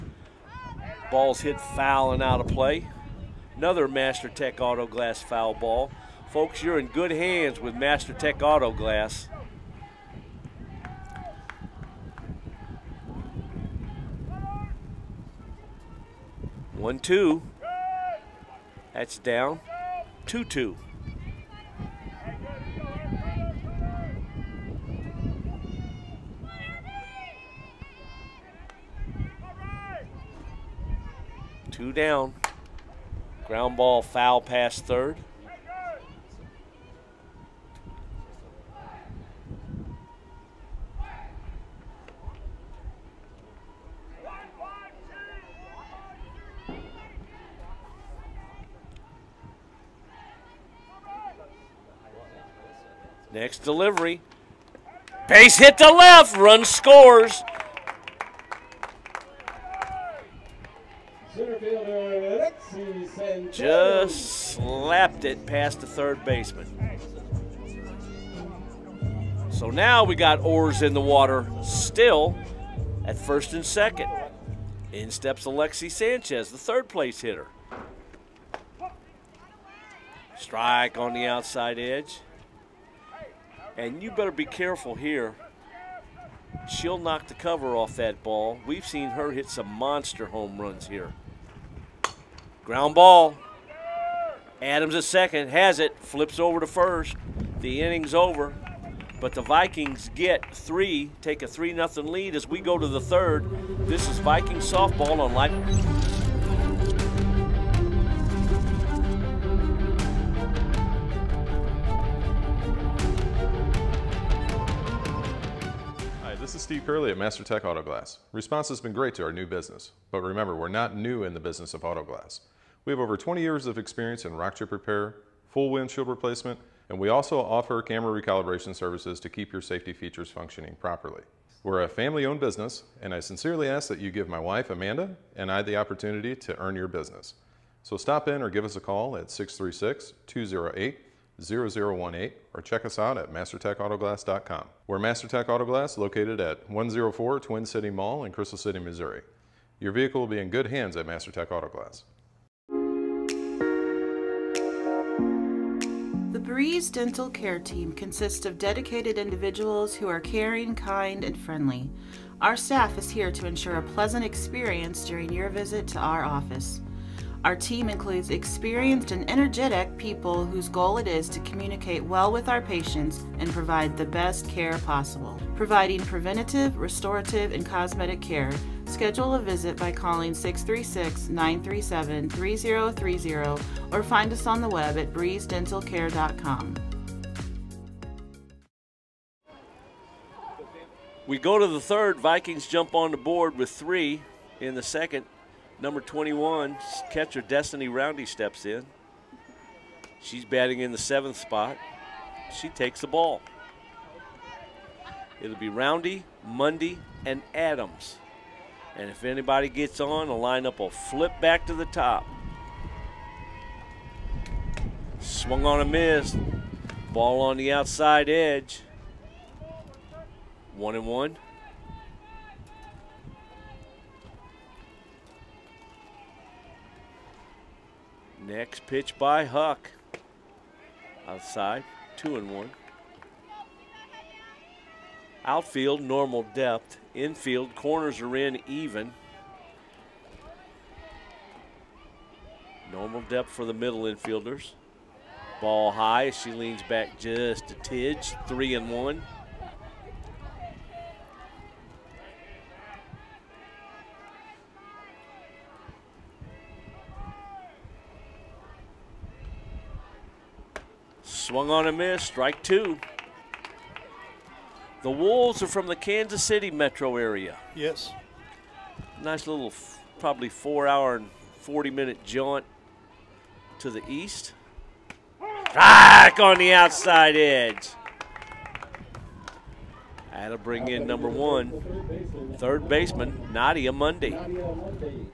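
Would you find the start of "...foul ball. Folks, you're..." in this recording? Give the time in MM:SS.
00:05.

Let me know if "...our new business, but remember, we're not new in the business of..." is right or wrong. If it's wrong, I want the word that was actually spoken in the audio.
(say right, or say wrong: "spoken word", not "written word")
right.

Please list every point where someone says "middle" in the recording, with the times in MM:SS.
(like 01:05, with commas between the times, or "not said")
04:03.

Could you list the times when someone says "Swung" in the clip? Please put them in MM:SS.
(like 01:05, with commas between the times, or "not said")
03:35, 04:21.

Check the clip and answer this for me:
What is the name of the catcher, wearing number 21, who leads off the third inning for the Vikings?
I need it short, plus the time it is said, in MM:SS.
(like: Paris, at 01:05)
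Destiny Roundy, at 03:17.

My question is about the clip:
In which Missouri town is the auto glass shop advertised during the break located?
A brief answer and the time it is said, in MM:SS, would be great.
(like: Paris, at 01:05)
Crystal City, at 02:28.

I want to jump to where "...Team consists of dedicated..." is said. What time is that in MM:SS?
02:37.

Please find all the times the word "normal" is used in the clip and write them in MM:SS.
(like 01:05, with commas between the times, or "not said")
03:56, 04:02.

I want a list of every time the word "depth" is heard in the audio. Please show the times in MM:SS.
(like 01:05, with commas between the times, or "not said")
03:56, 04:03.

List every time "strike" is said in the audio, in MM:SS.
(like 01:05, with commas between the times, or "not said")
01:20, 04:22.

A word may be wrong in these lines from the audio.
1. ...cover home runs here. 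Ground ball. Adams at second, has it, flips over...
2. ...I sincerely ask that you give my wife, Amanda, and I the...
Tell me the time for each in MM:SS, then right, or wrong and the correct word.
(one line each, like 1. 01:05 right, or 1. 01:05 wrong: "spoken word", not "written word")
1. 01:29 wrong: "monster", not "cover"
2. 02:13 right.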